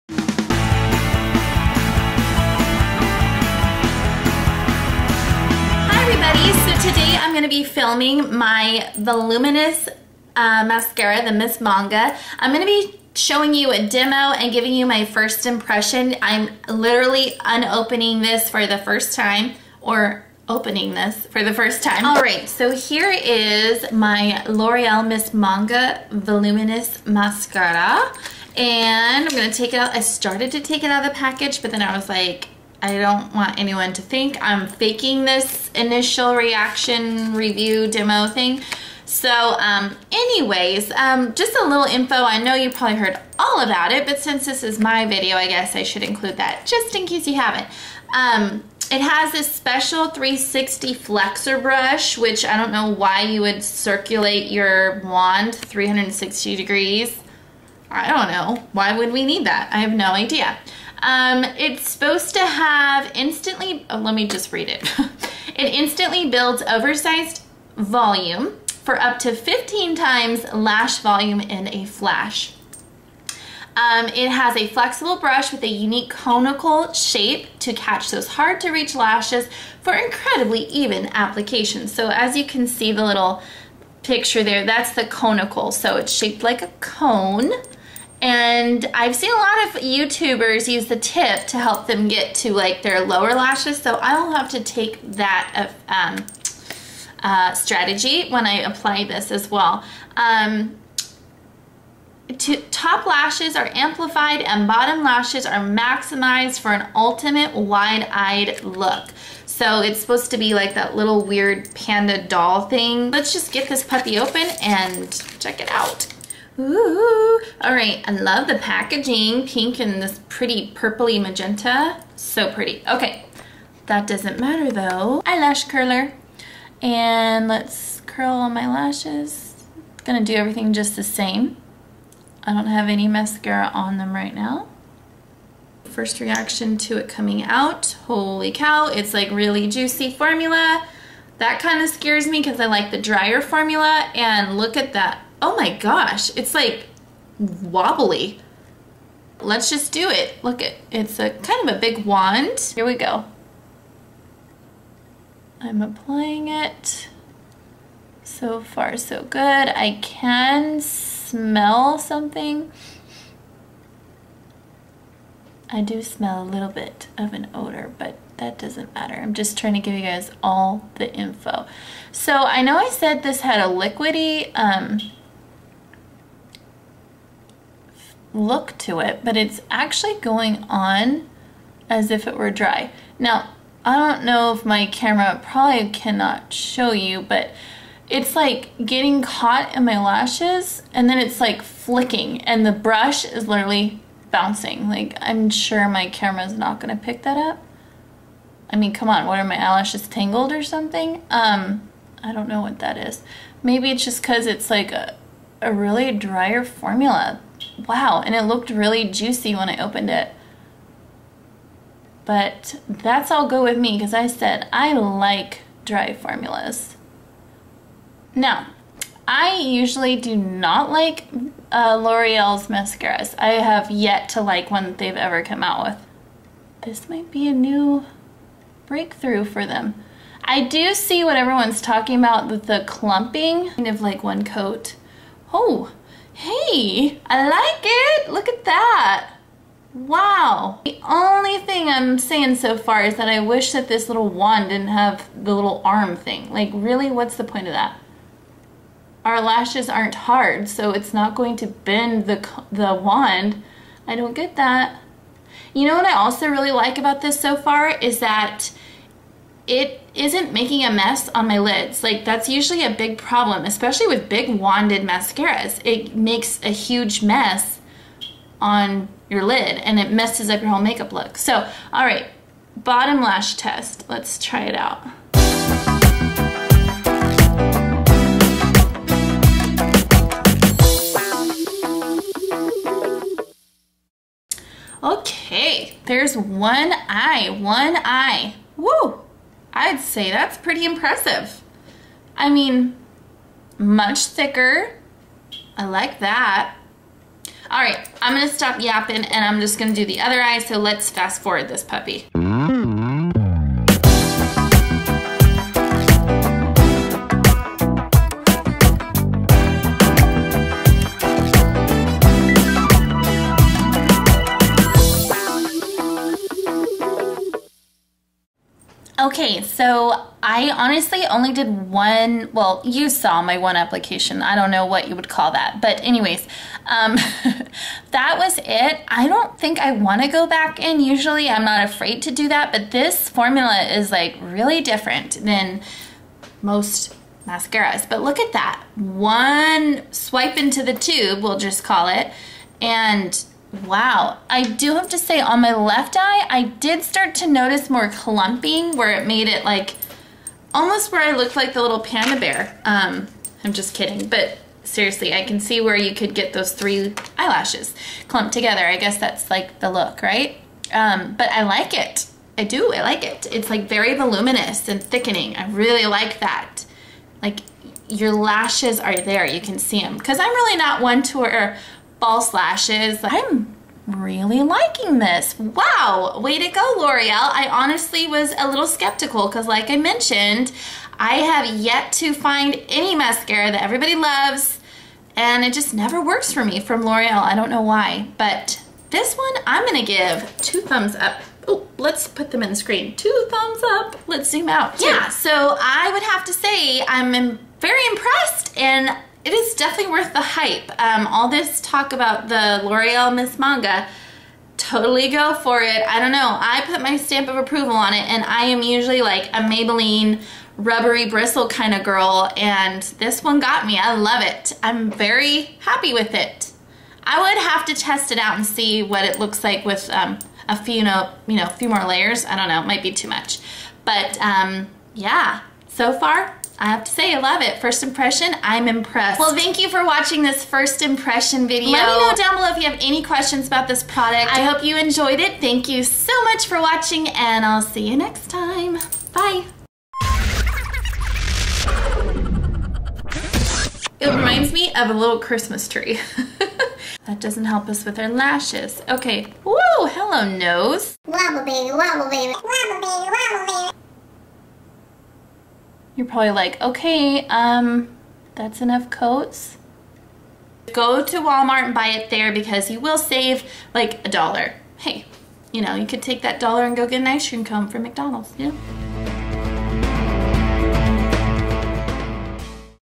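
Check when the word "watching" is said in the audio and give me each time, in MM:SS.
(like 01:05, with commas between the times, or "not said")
07:10, 07:16.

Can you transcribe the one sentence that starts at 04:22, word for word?
Like that's usually a big problem, especially with big wanded mascaras.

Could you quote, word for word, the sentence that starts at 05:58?
I guess that's like the look, right?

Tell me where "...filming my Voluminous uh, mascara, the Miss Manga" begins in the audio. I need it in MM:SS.
00:07.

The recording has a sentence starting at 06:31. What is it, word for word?
Oh, let's put them in the screen.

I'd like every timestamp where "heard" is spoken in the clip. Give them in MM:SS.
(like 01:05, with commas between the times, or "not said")
00:42.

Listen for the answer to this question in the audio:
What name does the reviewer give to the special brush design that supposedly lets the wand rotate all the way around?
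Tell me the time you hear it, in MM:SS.
00:50.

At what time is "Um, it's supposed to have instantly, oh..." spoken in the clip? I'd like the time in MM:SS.
01:01.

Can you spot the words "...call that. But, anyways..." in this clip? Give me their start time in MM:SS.
05:25.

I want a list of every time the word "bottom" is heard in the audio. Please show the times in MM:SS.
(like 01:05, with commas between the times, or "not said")
01:44, 04:32.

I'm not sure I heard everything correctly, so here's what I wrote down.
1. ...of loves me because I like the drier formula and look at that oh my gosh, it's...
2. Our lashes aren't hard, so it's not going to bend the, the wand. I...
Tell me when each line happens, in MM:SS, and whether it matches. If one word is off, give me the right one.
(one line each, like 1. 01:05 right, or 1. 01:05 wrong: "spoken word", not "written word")
1. 02:21 wrong: "scares", not "loves"
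2. 04:09 right.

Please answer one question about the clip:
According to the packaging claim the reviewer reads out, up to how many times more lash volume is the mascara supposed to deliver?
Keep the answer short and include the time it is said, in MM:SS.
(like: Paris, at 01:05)
15 times, at 01:09.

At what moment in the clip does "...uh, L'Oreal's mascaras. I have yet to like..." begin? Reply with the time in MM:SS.
03:41.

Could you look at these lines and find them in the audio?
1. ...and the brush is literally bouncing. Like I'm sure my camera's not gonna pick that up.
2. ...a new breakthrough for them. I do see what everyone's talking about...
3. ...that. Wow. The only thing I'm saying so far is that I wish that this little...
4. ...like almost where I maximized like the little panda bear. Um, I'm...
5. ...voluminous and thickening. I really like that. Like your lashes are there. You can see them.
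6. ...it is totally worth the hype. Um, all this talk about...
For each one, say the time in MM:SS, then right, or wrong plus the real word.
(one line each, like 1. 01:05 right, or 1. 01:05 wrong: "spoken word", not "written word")
1. 03:12 right
2. 03:47 right
3. 03:58 right
4. 05:49 wrong: "looked", not "maximized"
5. 06:04 right
6. 06:39 wrong: "definitely", not "totally".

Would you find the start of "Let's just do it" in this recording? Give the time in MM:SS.
02:29.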